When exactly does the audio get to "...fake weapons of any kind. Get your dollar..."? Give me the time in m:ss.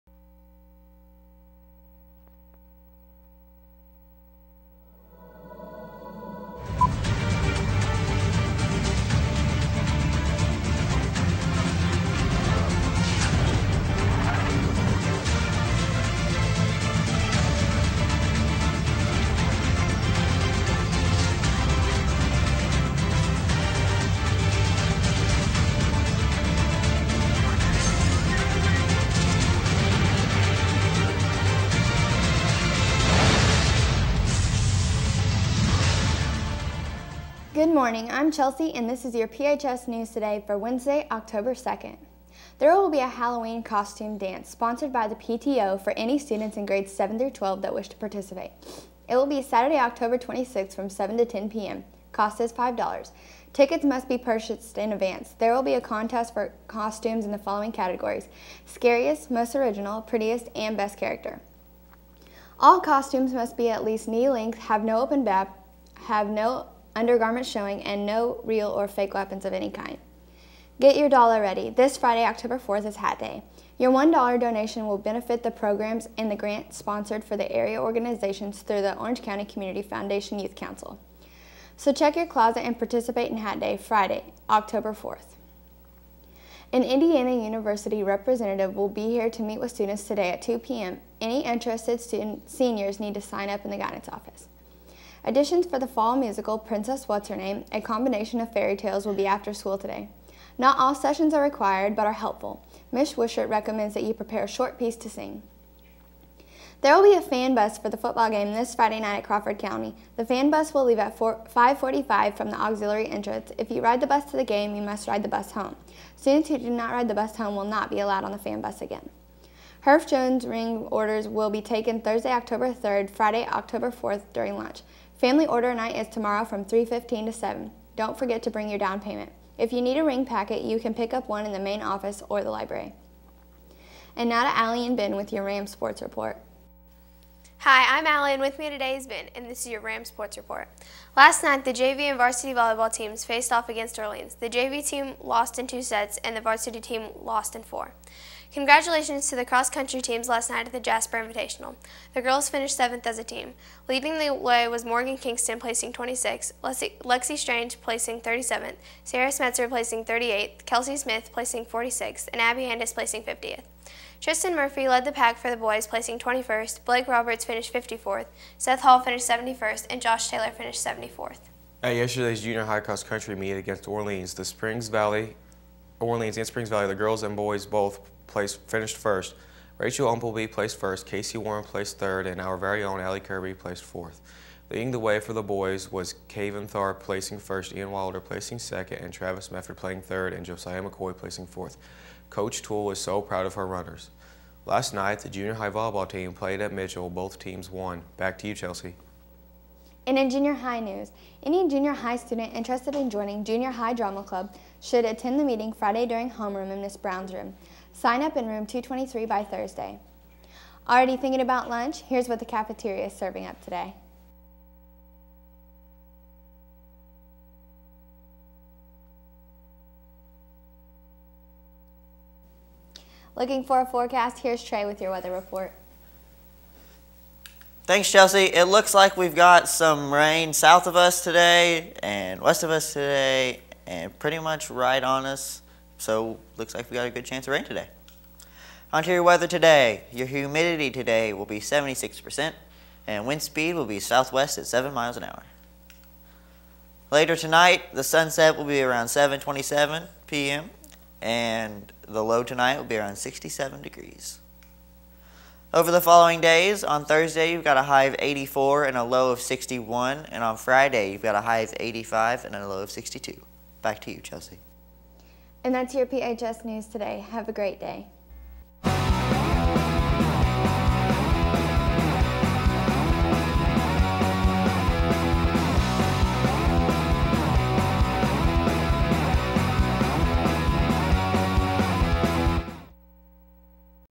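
1:08.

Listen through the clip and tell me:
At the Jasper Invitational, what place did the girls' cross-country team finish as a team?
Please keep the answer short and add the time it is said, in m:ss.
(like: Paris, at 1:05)
7th, at 2:32.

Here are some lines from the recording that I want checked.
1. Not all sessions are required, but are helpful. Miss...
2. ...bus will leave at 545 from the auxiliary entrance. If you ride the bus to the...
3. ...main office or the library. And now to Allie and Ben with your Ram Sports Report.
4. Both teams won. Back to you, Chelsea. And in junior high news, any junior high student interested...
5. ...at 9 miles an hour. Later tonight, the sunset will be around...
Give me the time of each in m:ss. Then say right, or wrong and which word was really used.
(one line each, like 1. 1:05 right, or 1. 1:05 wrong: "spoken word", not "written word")
1. 1:40 right
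2. 1:50 right
3. 2:11 right
4. 3:17 right
5. 4:04 wrong: "7", not "9".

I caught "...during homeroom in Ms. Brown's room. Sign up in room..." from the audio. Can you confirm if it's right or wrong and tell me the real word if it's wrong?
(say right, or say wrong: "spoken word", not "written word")
right.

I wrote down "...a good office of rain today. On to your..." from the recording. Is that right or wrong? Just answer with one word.
wrong.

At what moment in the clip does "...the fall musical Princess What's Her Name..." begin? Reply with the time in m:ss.
1:35.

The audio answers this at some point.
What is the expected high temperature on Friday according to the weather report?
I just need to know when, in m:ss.
4:21.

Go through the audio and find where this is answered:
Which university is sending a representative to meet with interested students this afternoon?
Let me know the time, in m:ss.
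1:26.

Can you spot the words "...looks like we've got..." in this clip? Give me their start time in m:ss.
3:48.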